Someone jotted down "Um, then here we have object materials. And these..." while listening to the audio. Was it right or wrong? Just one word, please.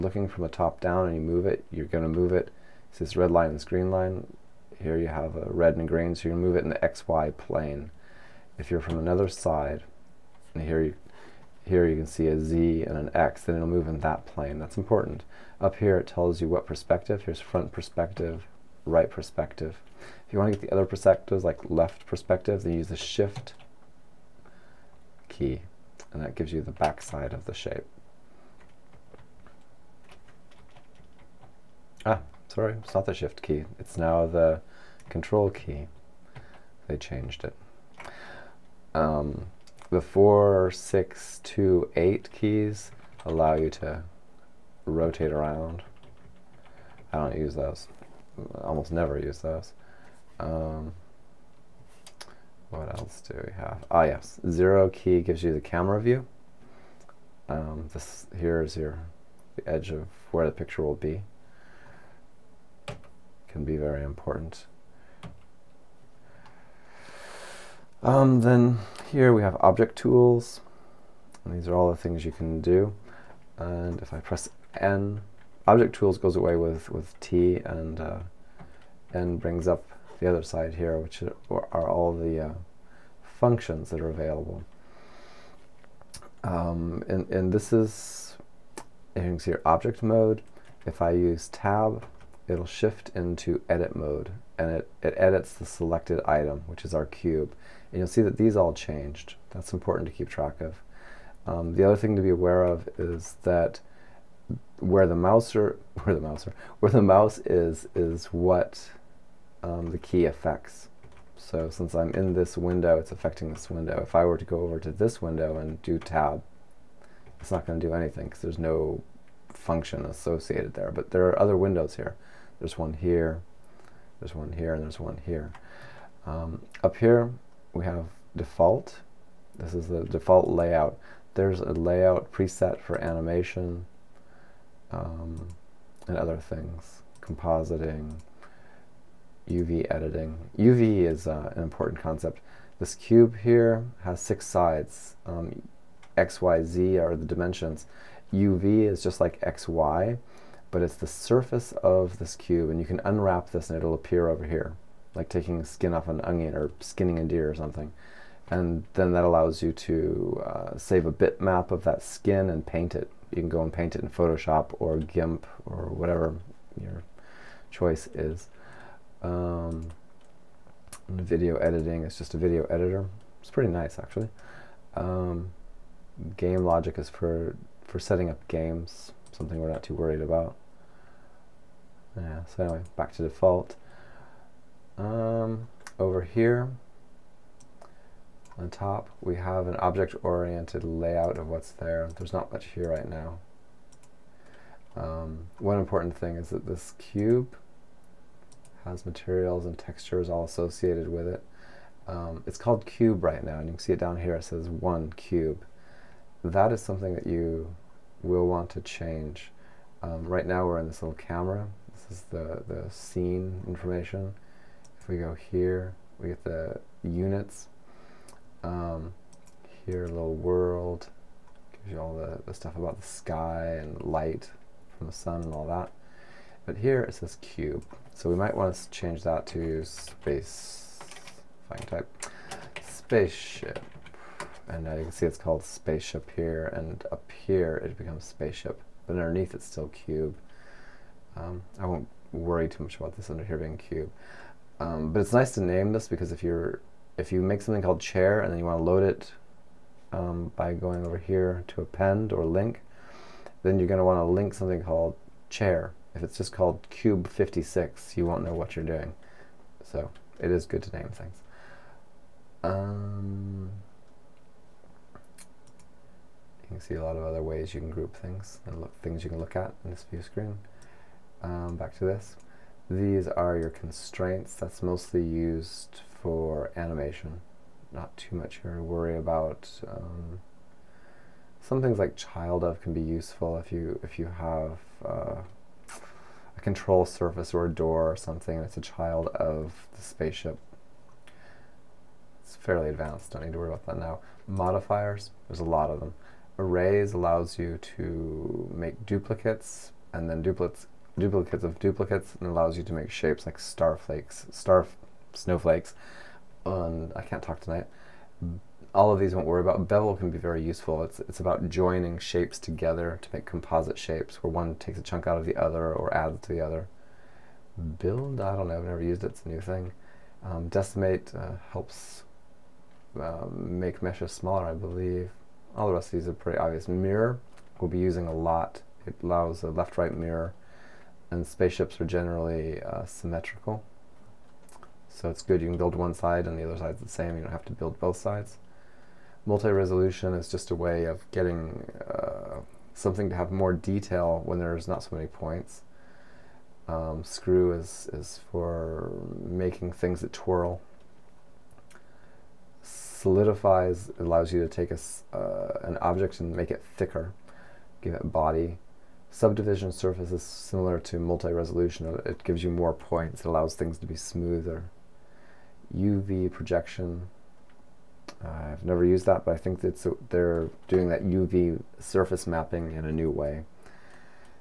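wrong.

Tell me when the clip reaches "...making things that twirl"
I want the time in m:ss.
5:49.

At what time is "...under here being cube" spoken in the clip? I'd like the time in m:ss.
4:03.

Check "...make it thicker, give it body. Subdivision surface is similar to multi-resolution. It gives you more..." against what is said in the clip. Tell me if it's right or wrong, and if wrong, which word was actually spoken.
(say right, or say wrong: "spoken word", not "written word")
right.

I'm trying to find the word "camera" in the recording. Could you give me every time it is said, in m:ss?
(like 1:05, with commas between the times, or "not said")
0:55, 3:31.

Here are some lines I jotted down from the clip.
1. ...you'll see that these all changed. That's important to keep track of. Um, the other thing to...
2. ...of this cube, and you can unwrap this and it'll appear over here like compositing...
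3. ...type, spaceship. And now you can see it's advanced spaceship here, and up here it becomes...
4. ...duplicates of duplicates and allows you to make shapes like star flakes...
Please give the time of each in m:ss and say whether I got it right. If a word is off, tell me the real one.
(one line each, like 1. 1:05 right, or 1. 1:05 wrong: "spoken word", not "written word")
1. 1:37 right
2. 2:31 wrong: "taking", not "compositing"
3. 3:51 wrong: "called", not "advanced"
4. 5:01 right.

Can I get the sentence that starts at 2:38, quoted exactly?
And then that allows you to uh, save a bitmap of that skin and paint it.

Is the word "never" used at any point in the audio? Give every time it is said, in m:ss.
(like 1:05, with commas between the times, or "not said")
0:48, 5:18, 6:08.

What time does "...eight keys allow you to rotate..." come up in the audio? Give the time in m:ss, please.
0:41.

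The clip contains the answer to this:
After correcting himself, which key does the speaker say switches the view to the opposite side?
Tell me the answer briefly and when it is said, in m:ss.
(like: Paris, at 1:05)
Control key, at 0:35.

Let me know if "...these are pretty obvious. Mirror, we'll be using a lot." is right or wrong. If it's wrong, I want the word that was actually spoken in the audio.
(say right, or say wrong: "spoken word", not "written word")
right.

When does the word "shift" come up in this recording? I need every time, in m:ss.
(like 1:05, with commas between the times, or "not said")
0:22, 0:33, 1:32.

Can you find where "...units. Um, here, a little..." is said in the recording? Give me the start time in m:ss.
3:37.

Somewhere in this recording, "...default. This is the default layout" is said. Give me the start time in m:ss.
2:08.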